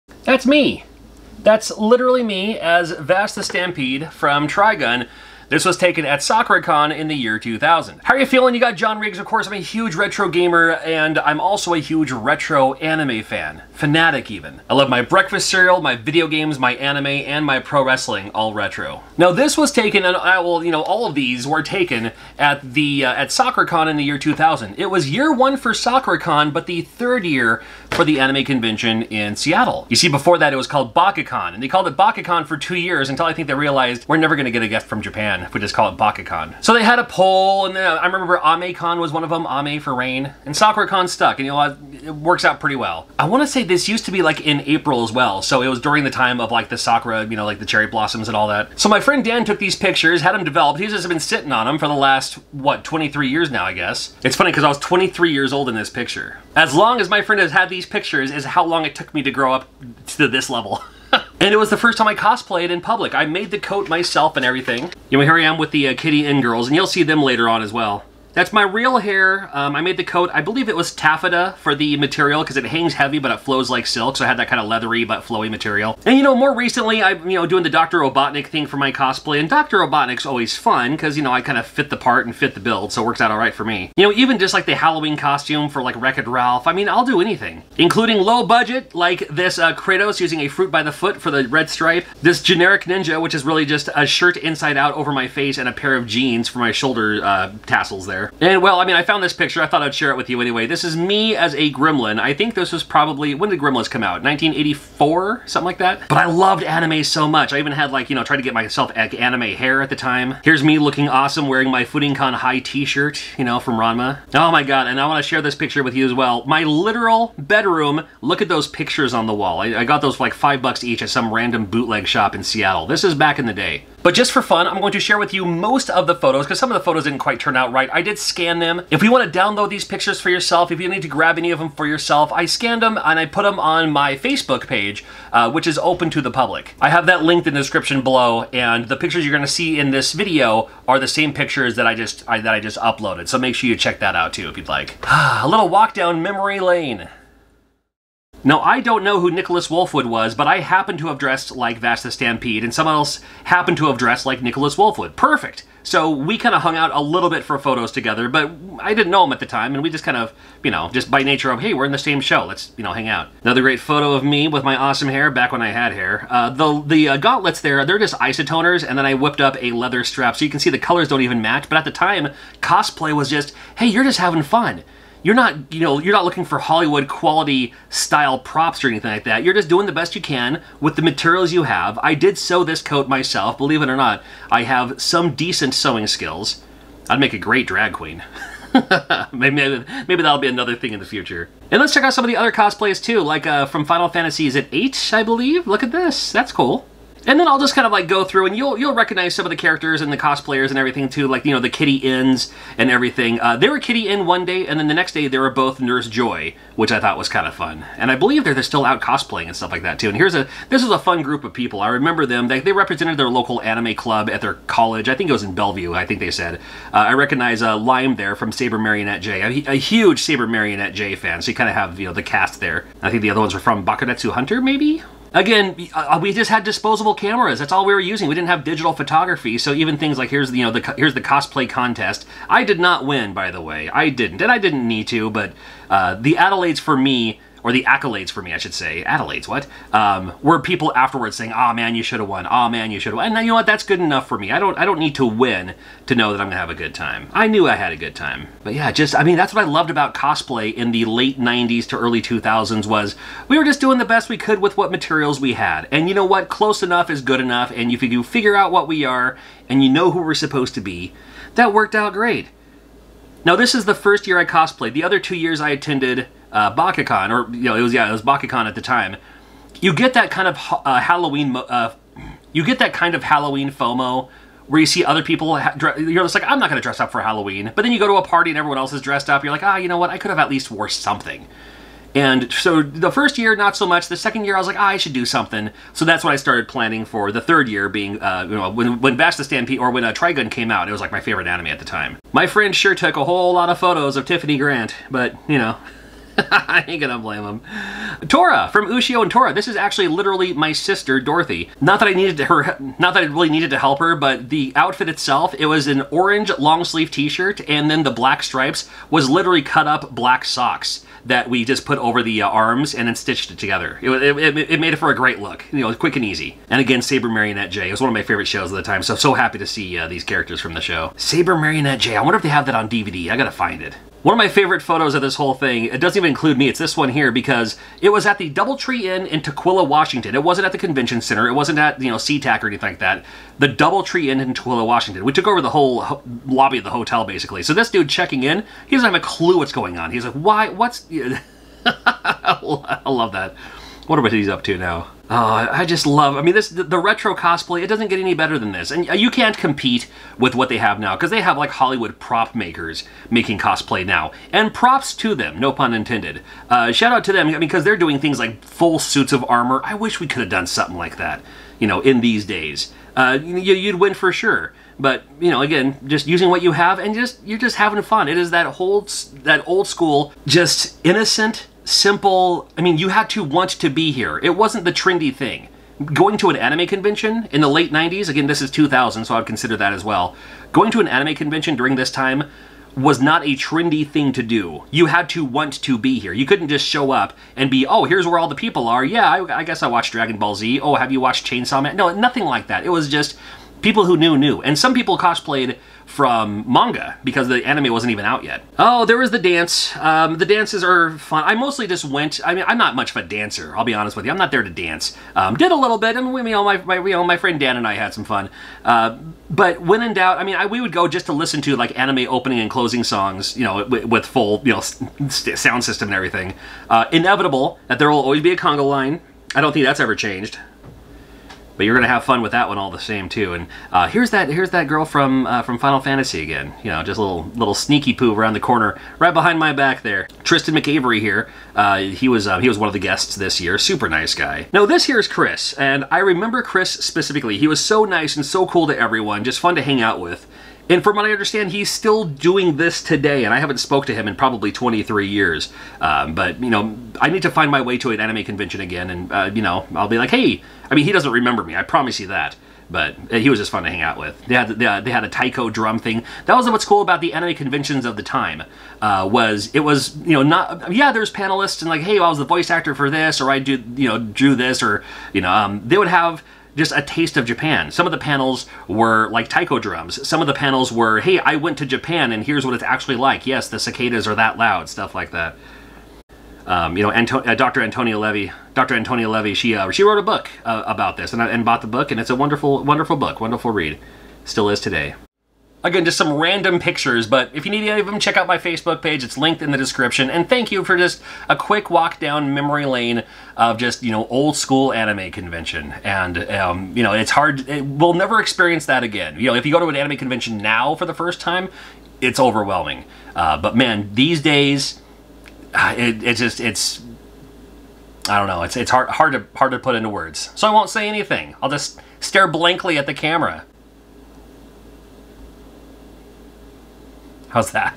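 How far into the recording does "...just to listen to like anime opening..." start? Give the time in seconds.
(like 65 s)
411 s.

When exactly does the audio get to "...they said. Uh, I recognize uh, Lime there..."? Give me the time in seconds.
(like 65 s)
216 s.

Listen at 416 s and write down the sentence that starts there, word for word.
Uh, inevitable that there will always be a conga line.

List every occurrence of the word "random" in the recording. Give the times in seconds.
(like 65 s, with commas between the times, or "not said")
121 s, 486 s.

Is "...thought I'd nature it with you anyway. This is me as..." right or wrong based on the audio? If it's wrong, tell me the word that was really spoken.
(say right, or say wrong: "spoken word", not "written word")
wrong: "share", not "nature".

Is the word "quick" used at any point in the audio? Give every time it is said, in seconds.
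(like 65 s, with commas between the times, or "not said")
315 s, 491 s.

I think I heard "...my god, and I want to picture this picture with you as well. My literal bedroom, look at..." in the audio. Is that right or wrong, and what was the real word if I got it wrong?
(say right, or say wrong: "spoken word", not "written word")
wrong: "share", not "picture".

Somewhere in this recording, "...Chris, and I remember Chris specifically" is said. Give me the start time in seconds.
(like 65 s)
435 s.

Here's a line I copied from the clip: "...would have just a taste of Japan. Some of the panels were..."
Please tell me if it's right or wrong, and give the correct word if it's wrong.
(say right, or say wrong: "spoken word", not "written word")
right.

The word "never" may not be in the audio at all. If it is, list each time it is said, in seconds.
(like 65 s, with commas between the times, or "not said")
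34 s, 498 s.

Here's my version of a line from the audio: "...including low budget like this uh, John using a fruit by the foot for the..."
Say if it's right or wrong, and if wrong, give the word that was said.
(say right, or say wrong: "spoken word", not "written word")
wrong: "Kratos", not "John".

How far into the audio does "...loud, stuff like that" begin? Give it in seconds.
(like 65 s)
474 s.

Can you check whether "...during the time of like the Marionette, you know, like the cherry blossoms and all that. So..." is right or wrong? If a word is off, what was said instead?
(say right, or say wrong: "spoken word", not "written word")
wrong: "Sakura", not "Marionette".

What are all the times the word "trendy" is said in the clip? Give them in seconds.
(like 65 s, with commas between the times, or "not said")
374 s, 383 s.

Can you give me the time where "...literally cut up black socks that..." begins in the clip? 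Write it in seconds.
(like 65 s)
309 s.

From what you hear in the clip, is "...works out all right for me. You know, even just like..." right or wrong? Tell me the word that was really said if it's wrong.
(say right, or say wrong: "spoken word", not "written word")
right.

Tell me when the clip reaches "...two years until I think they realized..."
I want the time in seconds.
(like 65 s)
32 s.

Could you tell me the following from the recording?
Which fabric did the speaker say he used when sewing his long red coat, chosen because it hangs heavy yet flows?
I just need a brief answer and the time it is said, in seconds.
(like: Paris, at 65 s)
taffeta, at 70 s.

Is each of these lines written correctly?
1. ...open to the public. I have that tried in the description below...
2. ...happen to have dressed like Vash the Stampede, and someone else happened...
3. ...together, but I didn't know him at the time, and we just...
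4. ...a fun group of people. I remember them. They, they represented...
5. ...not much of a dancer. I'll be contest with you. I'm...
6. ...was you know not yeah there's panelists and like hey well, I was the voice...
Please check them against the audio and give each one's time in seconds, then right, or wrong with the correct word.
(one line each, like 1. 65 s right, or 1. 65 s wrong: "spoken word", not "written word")
1. 135 s wrong: "linked", not "tried"
2. 150 s right
3. 157 s right
4. 210 s right
5. 402 s wrong: "honest", not "contest"
6. 459 s right.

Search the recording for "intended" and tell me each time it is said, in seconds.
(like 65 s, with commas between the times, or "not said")
355 s.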